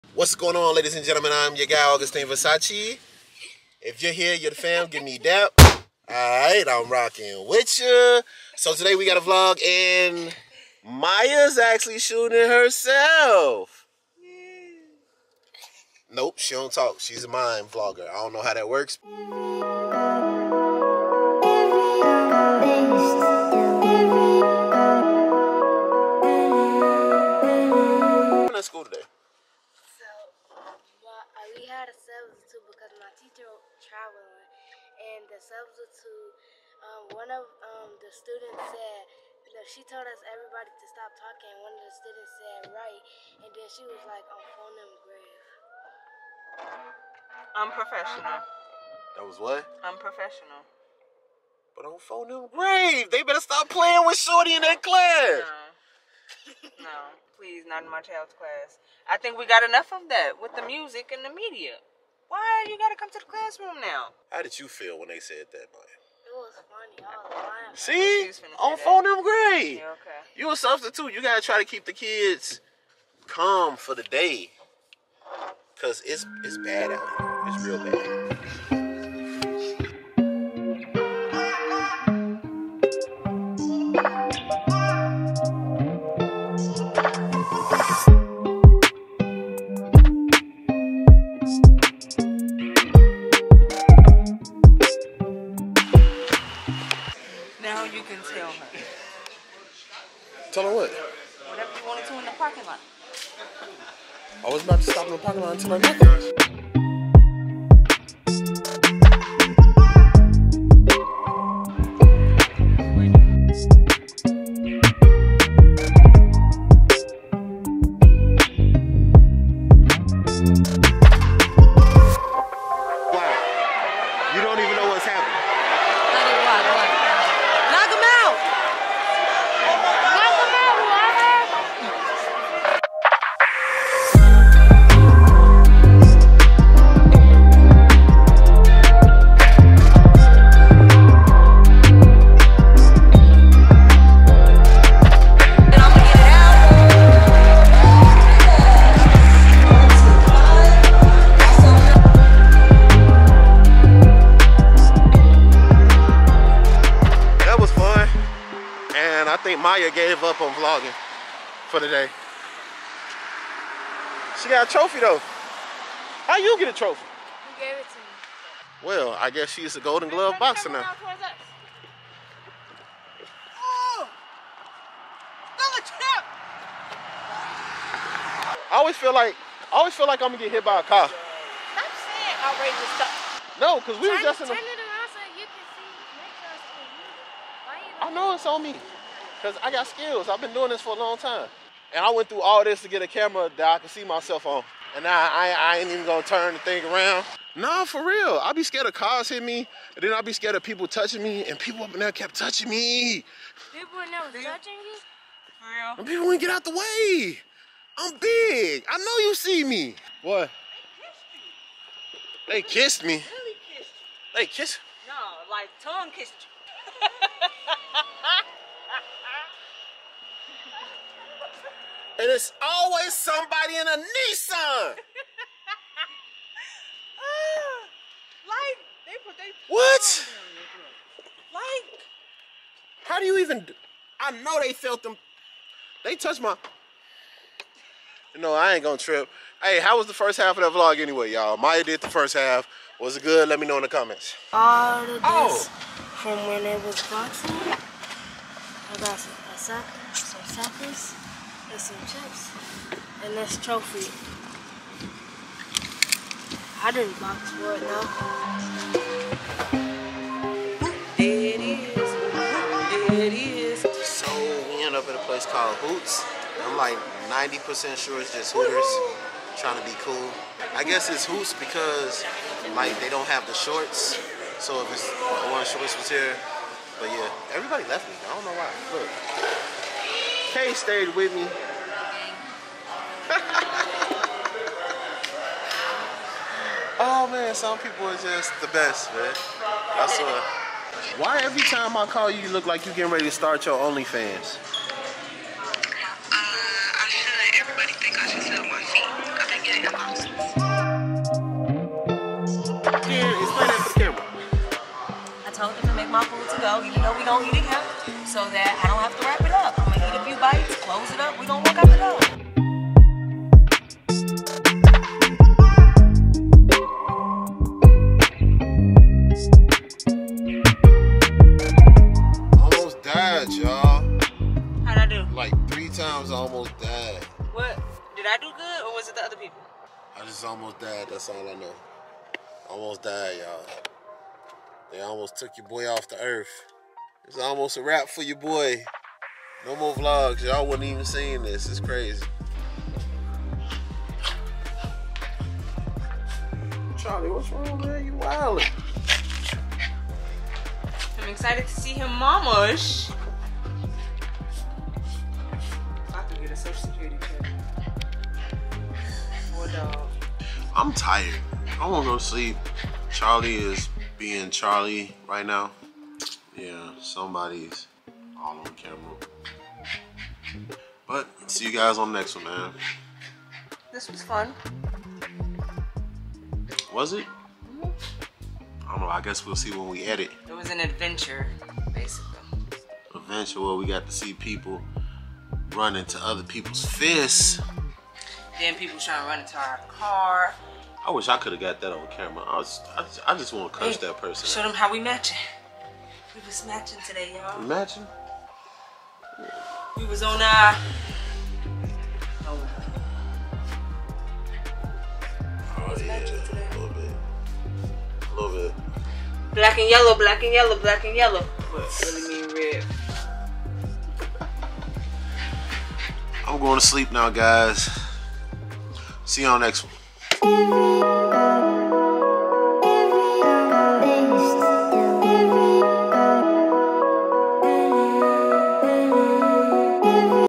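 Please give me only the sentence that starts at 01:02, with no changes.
Why you gotta come to the classroom now?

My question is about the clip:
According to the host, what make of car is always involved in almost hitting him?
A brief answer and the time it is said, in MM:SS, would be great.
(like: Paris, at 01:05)
Nissan, at 03:43.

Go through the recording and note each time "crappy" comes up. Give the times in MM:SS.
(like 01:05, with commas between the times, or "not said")
not said.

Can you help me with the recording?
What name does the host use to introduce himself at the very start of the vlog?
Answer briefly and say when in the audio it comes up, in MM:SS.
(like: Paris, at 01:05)
Augustine Versace, at 00:01.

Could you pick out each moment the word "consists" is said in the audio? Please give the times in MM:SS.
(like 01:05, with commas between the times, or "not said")
not said.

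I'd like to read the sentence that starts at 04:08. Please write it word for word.
I got some pasacas, some tacos, and some chips, and this trophy.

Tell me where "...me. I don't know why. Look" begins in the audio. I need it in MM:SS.
04:38.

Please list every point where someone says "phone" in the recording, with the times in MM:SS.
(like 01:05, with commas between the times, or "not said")
00:44, 00:51, 01:08.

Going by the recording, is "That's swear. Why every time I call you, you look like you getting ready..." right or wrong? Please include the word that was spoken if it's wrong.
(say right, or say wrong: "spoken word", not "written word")
right.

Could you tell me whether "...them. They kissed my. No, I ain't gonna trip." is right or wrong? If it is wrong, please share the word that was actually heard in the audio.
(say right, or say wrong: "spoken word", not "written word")
wrong: "touched", not "kissed".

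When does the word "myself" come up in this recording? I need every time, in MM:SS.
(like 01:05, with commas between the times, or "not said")
03:14.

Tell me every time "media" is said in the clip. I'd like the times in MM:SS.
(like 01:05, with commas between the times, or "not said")
01:01.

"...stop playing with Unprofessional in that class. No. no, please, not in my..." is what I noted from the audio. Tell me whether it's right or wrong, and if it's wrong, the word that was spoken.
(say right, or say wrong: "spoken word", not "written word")
wrong: "Shorty", not "Unprofessional".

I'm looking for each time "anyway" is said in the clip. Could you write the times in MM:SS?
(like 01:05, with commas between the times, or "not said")
04:00.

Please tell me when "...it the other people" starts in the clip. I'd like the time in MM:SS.
05:29.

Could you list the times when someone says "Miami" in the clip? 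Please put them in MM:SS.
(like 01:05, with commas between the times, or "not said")
not said.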